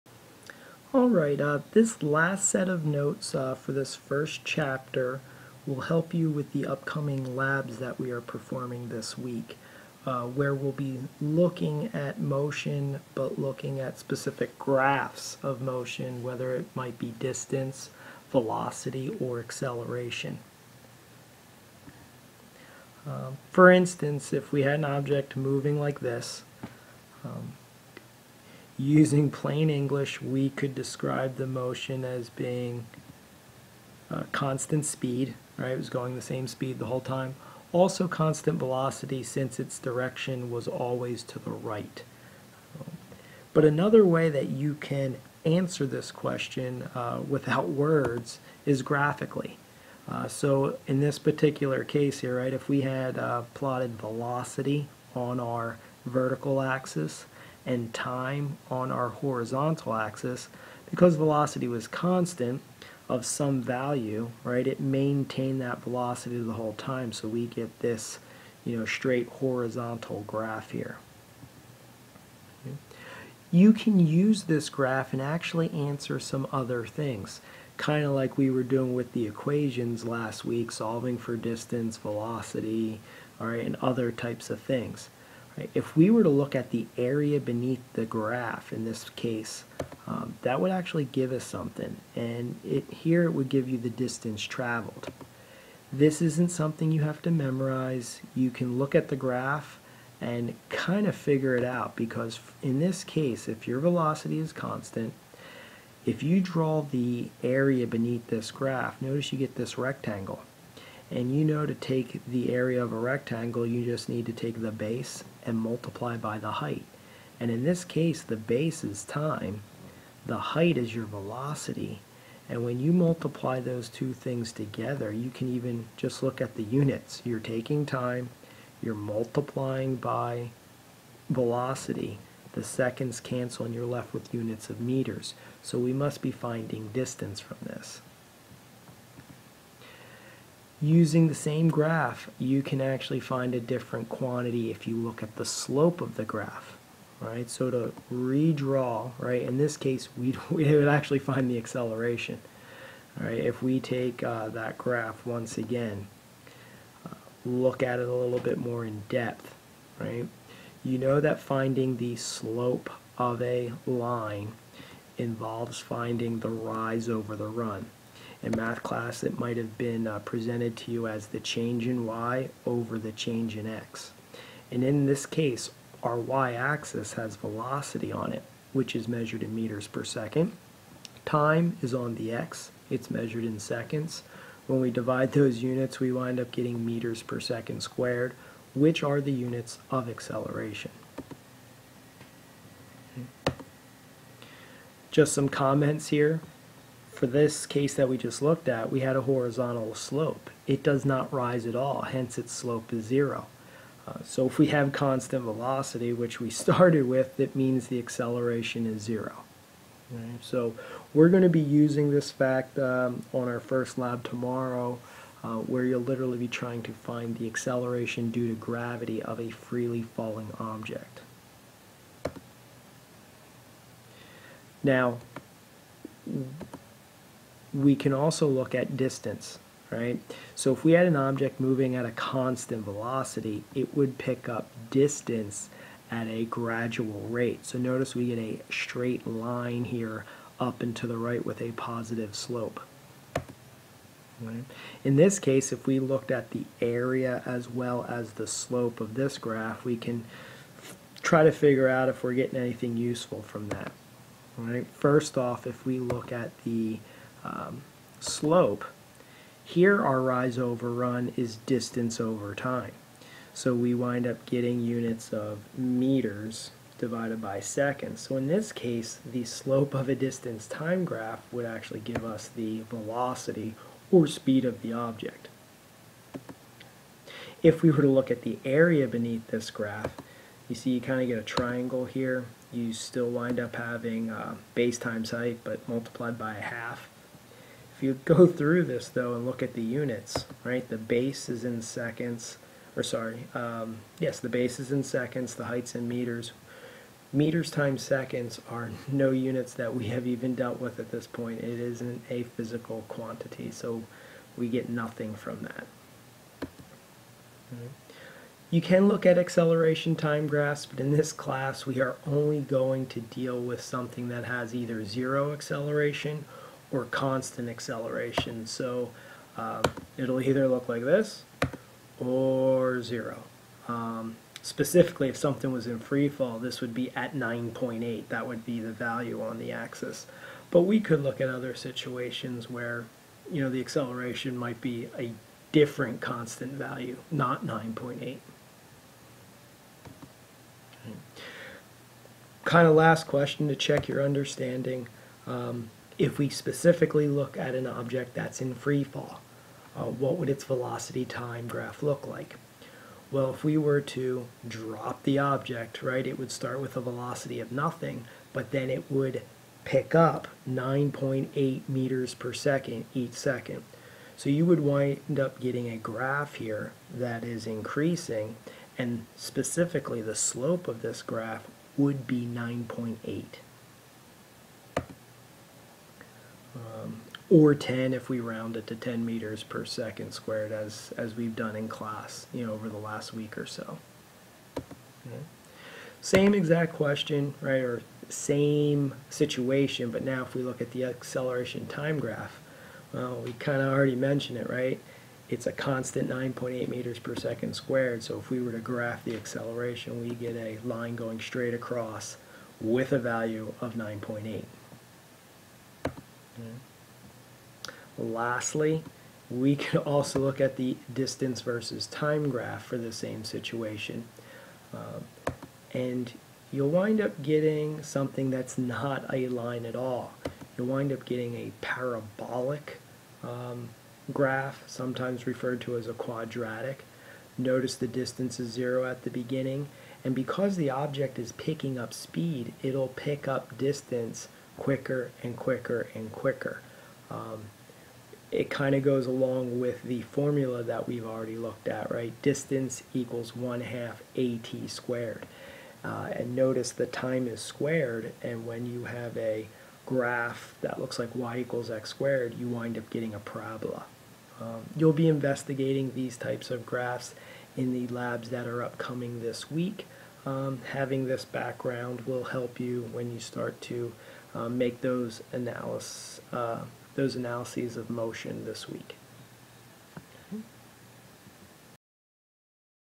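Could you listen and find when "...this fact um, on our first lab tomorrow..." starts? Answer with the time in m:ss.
3:32.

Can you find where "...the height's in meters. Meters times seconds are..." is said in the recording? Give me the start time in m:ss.
4:55.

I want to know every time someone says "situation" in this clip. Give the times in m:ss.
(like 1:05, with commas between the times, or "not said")
5:31, 6:29, 6:53.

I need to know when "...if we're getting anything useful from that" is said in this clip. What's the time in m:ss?
4:12.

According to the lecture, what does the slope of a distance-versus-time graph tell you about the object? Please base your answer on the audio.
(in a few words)
velocity or speed.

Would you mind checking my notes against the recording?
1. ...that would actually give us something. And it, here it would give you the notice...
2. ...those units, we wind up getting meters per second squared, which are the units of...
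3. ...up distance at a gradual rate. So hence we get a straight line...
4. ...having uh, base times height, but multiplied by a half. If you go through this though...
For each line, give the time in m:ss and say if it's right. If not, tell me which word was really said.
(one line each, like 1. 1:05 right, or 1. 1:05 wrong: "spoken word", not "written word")
1. 1:30 wrong: "distance", not "notice"
2. 3:05 right
3. 3:54 wrong: "notice", not "hence"
4. 4:43 right.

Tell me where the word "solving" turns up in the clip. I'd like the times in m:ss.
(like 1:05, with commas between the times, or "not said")
1:20.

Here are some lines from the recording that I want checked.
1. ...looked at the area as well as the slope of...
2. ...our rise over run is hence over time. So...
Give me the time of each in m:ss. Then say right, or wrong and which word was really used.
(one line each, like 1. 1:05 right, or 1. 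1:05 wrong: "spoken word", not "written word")
1. 4:05 right
2. 4:20 wrong: "distance", not "hence".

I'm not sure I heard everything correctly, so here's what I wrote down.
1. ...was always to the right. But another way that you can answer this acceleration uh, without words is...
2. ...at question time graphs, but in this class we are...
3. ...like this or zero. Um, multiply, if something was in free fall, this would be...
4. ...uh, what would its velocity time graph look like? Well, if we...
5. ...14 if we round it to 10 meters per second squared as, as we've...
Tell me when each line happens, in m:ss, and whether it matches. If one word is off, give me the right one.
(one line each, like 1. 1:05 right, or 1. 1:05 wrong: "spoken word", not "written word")
1. 0:40 wrong: "question", not "acceleration"
2. 5:09 wrong: "acceleration", not "question"
3. 5:20 wrong: "specifically", not "multiply"
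4. 5:49 right
5. 6:17 wrong: "10", not "14".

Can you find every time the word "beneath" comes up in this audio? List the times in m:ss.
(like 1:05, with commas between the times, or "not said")
1:27, 1:47, 4:39.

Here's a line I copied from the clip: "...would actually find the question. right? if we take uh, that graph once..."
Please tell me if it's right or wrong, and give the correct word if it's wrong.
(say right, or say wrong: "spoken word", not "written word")
wrong: "acceleration", not "question".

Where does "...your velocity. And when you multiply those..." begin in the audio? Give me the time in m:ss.
2:00.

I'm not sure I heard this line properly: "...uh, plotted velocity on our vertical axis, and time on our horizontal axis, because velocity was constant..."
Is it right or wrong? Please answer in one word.
right.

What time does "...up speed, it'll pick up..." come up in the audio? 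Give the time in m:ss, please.
7:11.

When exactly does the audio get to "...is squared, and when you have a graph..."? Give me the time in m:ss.
7:27.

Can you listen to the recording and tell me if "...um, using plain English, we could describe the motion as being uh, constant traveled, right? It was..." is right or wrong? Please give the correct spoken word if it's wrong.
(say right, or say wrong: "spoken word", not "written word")
wrong: "speed", not "traveled".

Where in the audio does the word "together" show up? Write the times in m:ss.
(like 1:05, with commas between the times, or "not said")
2:04.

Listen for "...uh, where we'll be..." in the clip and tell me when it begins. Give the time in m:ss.
0:10.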